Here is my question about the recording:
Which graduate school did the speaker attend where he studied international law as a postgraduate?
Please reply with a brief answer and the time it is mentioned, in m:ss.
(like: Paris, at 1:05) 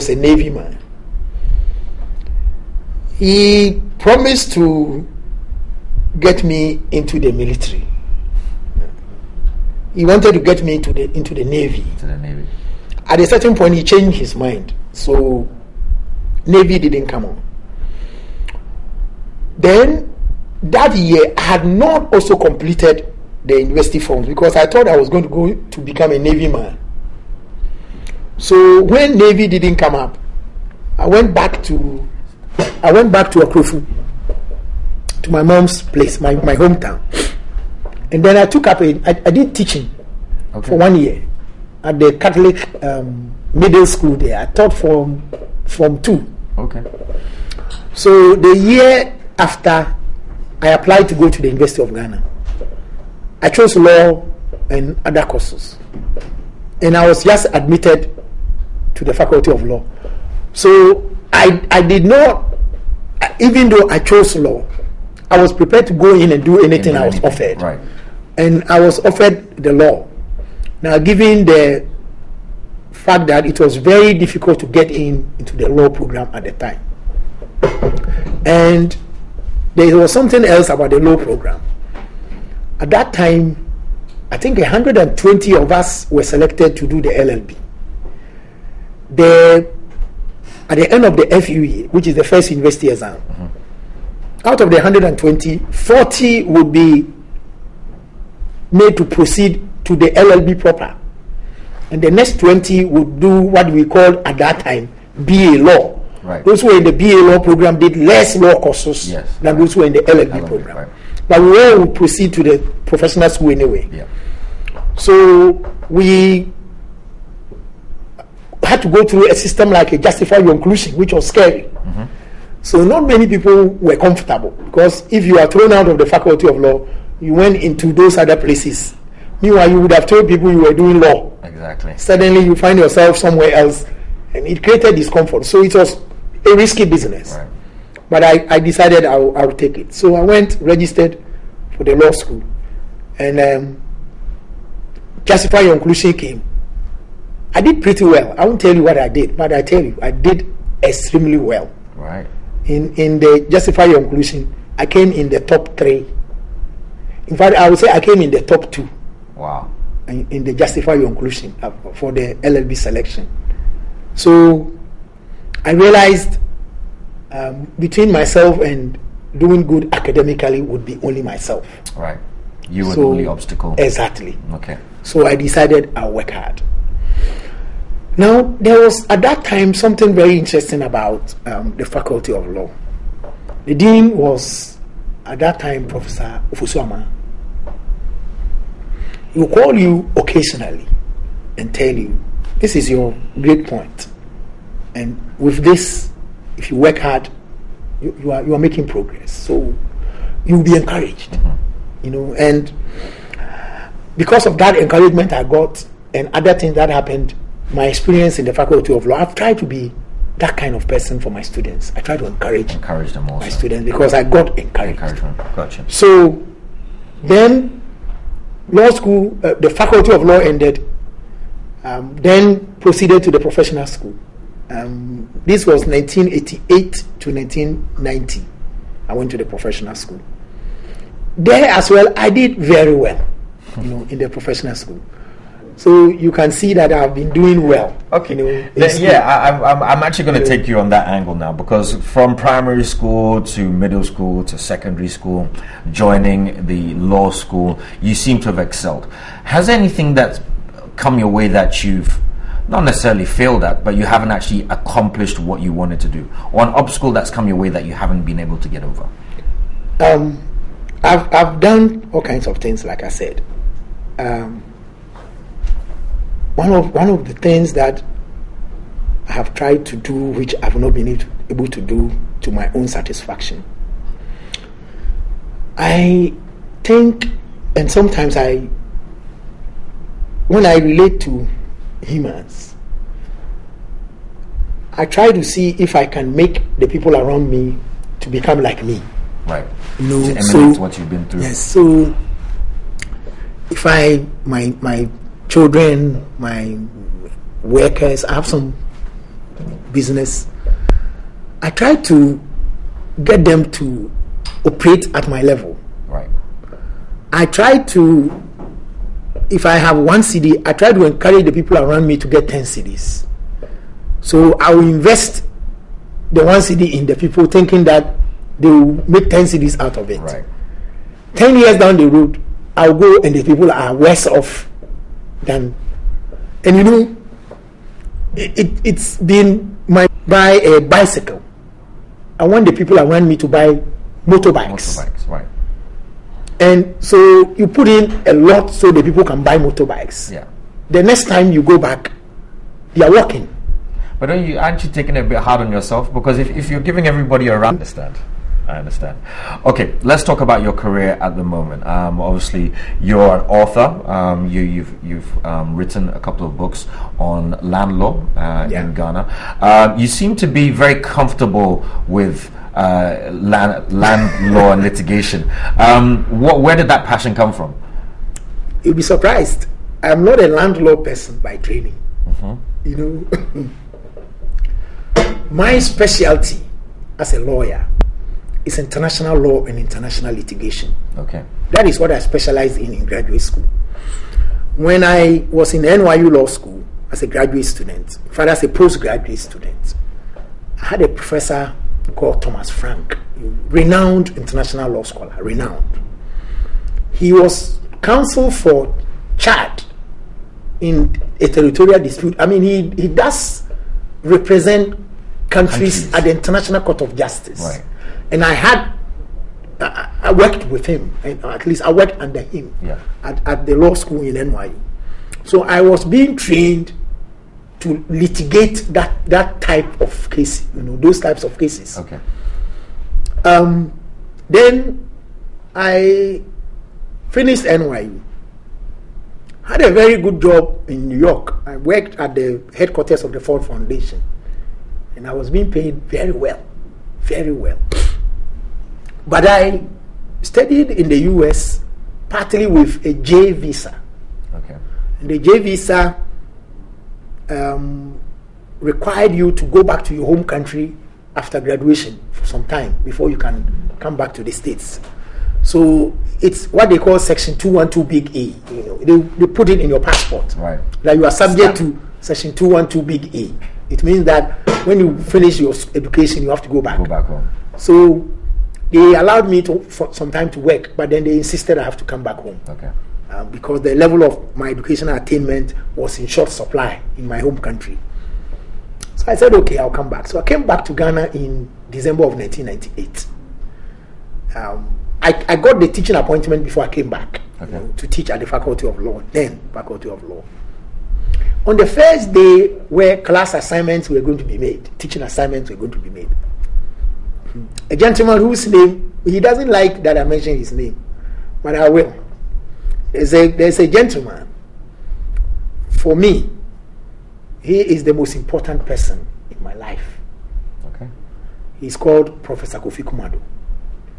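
NYU Law School, at 6:25.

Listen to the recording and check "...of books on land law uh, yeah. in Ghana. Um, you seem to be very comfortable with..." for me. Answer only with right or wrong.
right.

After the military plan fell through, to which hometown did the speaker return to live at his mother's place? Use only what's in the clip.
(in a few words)
Akrofu.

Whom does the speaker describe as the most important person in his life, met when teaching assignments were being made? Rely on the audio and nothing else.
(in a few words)
Professor Kofi Kumado.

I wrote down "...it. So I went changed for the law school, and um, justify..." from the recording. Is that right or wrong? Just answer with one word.
wrong.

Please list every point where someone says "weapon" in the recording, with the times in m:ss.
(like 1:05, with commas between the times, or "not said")
not said.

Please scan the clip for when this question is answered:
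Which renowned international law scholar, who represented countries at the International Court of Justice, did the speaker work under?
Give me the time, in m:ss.
6:32.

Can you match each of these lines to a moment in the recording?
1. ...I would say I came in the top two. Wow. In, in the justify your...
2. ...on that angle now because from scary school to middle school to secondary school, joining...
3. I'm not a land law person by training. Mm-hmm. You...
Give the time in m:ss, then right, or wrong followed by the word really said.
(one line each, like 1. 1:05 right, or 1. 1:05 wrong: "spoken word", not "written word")
1. 2:37 right
2. 4:00 wrong: "primary", not "scary"
3. 6:10 right.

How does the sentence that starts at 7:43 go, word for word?
It means that when you finish your education, you have to go back.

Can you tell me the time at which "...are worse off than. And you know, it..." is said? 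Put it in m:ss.
5:23.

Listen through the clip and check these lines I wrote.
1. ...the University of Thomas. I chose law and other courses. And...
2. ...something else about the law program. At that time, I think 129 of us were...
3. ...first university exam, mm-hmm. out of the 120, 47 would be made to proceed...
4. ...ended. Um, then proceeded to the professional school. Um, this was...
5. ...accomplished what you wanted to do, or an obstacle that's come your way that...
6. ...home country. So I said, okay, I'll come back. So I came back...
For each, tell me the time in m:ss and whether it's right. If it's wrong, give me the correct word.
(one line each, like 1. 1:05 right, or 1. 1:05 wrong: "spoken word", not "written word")
1. 0:51 wrong: "Ghana", not "Thomas"
2. 1:20 wrong: "120", not "129"
3. 1:32 wrong: "40", not "47"
4. 3:40 right
5. 4:14 right
6. 7:57 right.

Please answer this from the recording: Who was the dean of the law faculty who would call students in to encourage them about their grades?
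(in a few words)
Professor Ofosu-Amaah.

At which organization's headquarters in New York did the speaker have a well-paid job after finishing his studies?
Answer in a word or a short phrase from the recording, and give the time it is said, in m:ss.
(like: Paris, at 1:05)
Ford Foundation, at 7:13.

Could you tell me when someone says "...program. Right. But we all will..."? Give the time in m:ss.
1:50.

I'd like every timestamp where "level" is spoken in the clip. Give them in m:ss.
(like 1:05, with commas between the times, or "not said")
5:05, 7:53.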